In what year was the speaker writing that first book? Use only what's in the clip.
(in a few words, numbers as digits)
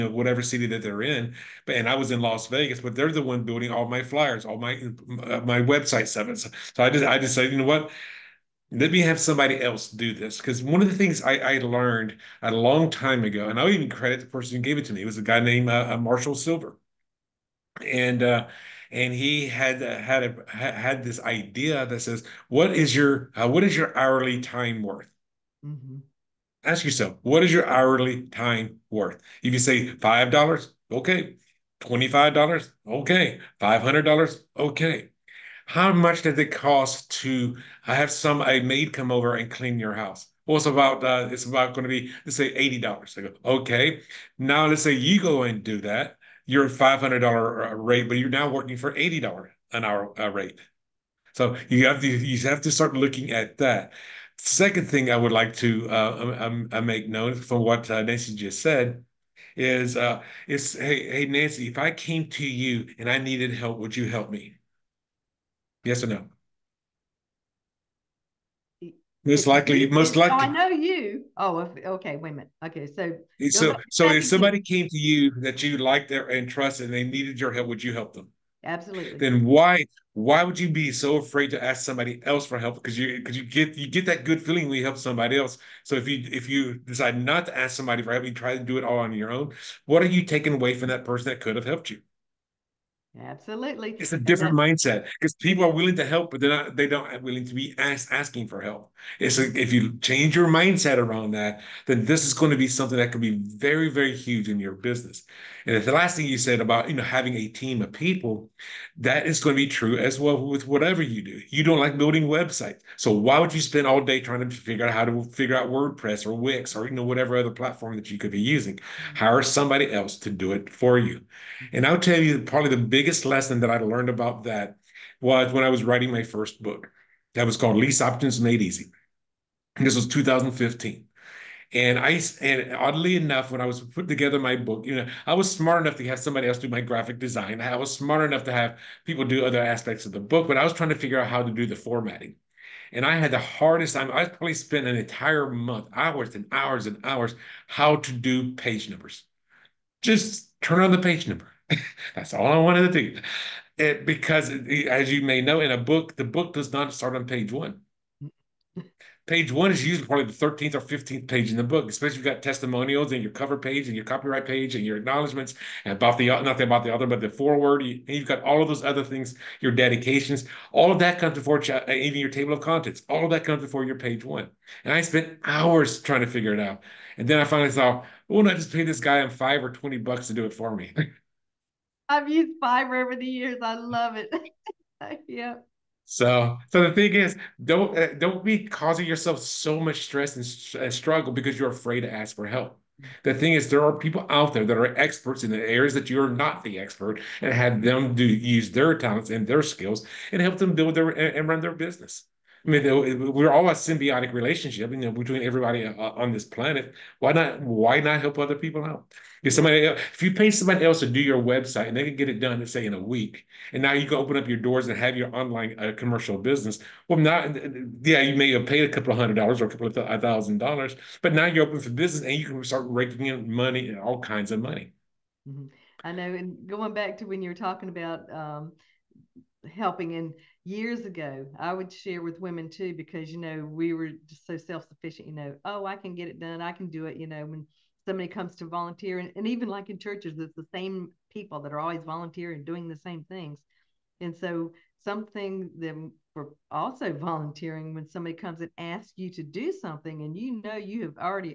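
2015.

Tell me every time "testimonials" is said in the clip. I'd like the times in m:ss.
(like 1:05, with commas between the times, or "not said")
2:42.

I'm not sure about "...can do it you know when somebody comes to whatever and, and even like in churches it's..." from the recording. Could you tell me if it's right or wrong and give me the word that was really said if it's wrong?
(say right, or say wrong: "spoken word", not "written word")
wrong: "volunteer", not "whatever".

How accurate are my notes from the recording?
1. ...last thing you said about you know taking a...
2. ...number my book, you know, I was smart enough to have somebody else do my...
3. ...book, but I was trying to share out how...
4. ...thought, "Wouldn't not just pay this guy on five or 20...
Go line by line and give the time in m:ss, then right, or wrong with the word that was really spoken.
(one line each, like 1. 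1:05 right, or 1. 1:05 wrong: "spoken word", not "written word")
1. 1:45 wrong: "having", not "taking"
2. 2:14 wrong: "together", not "number"
3. 2:20 wrong: "figure", not "share"
4. 2:57 right.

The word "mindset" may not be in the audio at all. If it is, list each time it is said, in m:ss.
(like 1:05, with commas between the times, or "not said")
1:34, 1:40.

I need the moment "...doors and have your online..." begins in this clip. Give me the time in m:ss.
3:34.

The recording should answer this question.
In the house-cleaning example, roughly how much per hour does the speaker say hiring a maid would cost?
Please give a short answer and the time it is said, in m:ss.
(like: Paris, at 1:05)
$80, at 0:42.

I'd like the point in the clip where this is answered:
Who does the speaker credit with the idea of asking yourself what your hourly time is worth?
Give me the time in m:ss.
0:15.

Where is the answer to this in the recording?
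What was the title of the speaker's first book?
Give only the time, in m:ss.
2:07.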